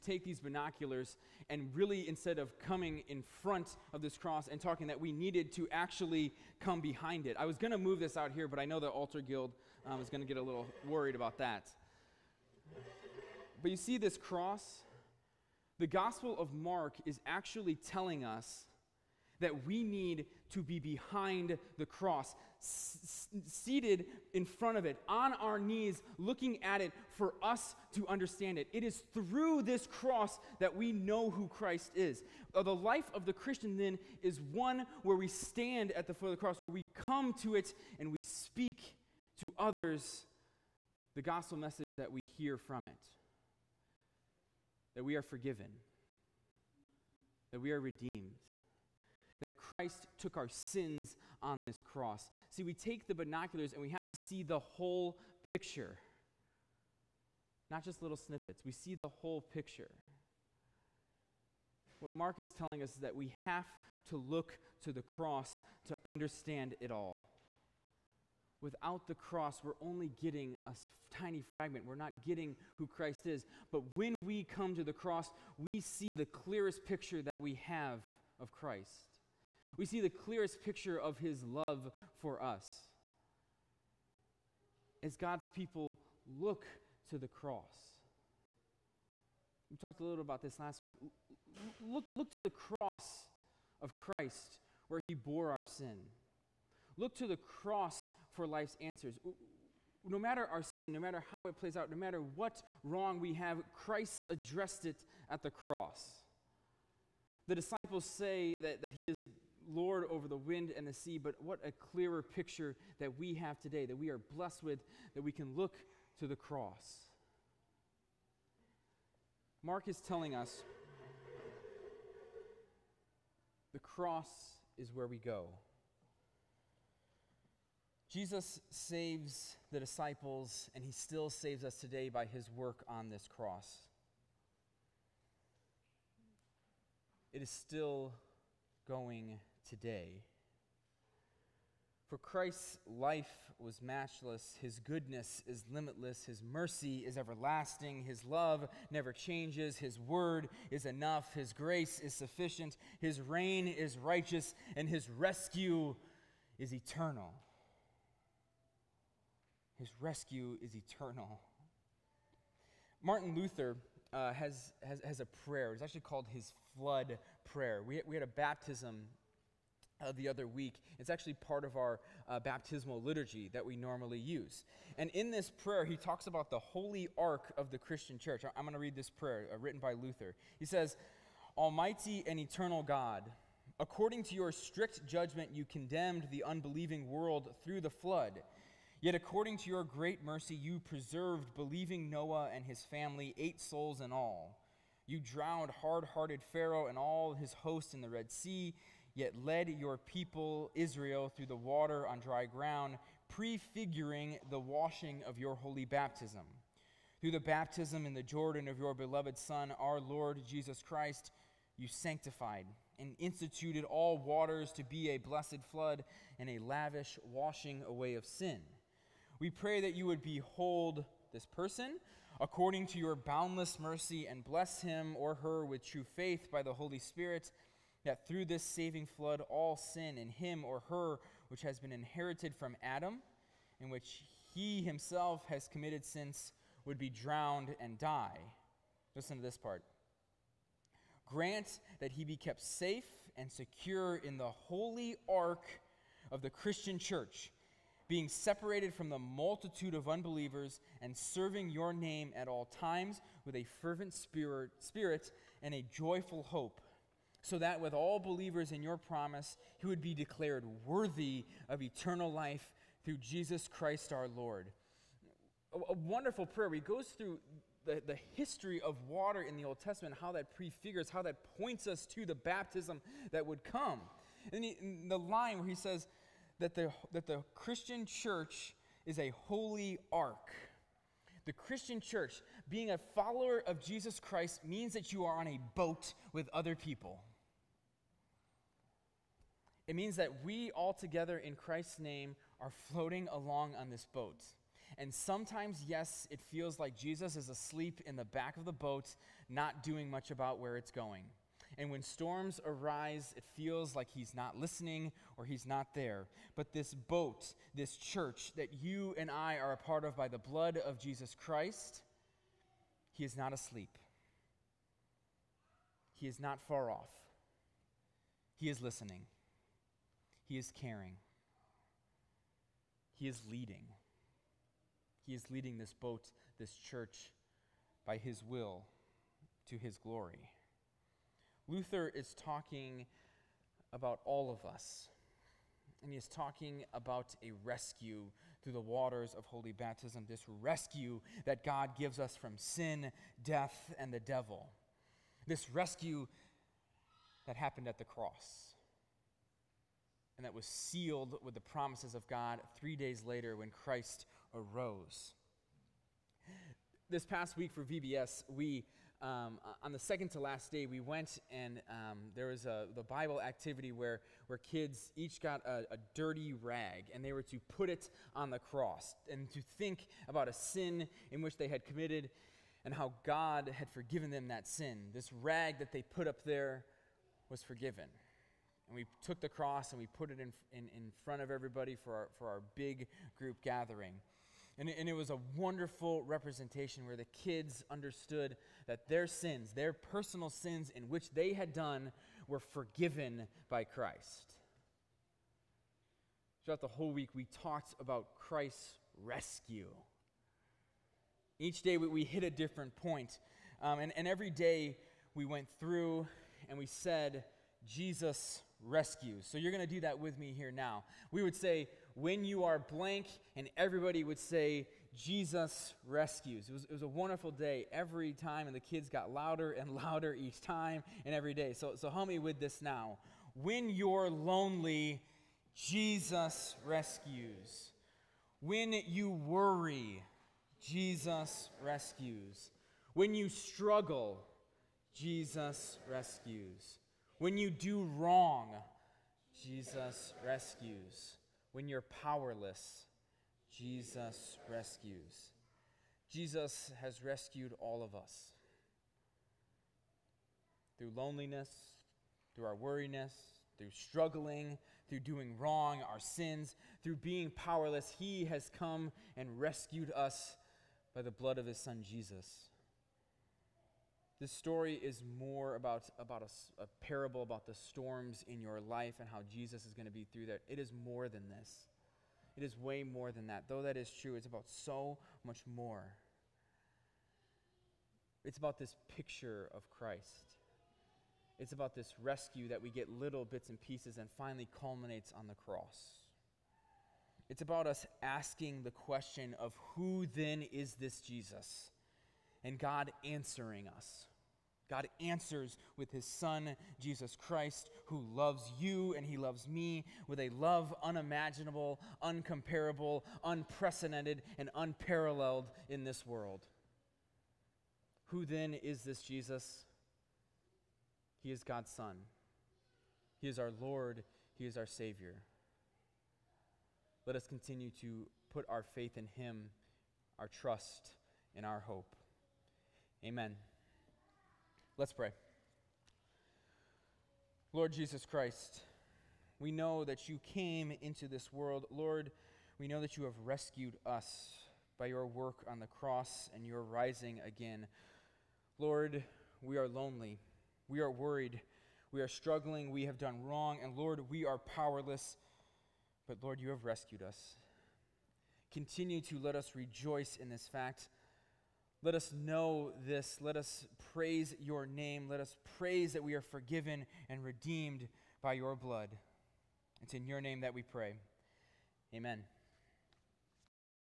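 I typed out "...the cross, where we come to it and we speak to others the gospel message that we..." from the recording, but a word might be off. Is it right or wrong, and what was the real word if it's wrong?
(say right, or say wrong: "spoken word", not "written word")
right.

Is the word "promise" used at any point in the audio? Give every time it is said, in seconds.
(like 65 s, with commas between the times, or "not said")
258 s, 351 s.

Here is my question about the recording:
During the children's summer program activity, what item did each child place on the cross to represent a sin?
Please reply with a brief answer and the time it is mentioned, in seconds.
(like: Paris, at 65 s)
Dirty rag, at 366 s.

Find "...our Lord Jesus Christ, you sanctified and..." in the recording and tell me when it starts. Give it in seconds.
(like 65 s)
209 s.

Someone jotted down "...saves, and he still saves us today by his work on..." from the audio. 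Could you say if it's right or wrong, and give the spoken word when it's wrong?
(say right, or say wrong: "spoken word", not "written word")
wrong: "disciples", not "saves".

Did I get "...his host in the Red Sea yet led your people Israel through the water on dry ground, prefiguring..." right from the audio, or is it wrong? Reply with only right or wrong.
right.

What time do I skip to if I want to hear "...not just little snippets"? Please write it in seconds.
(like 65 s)
57 s.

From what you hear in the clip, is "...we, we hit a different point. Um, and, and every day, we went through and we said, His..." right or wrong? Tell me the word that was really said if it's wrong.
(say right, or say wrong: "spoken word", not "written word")
wrong: "Jesus", not "His".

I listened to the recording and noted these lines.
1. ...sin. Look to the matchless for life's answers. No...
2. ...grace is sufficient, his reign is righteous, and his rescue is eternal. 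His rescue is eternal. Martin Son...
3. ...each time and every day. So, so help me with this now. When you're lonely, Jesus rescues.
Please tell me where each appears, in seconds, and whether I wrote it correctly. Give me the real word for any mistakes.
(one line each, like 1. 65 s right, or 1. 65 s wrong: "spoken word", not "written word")
1. 95 s wrong: "cross", not "matchless"
2. 151 s wrong: "Luther", not "Son"
3. 420 s right.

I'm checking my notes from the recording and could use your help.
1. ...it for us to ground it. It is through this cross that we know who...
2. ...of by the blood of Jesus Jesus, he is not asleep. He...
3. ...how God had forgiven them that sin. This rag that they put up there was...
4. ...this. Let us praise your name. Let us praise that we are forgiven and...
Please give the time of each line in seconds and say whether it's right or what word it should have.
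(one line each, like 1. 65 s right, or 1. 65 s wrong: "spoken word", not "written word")
1. 26 s wrong: "understand", not "ground"
2. 310 s wrong: "Christ", not "Jesus"
3. 372 s right
4. 553 s right.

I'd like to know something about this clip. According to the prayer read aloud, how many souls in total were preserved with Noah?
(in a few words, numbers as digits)
8.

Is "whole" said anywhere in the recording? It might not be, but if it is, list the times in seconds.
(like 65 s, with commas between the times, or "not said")
54 s, 59 s, 396 s.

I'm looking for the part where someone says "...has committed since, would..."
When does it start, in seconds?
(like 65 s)
235 s.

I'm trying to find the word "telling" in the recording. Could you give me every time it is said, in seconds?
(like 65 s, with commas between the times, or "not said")
17 s, 62 s, 120 s.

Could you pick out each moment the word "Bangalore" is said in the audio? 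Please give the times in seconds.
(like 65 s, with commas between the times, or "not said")
not said.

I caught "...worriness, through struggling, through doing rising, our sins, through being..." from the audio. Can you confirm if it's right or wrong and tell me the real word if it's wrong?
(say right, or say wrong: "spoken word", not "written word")
wrong: "wrong", not "rising".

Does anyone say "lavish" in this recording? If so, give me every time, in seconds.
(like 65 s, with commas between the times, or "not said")
216 s.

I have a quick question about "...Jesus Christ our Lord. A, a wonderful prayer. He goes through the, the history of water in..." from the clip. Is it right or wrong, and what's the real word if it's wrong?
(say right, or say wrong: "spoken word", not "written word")
right.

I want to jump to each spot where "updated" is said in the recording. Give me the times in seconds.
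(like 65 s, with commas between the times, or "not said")
not said.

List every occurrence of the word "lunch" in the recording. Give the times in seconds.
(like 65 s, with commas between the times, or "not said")
not said.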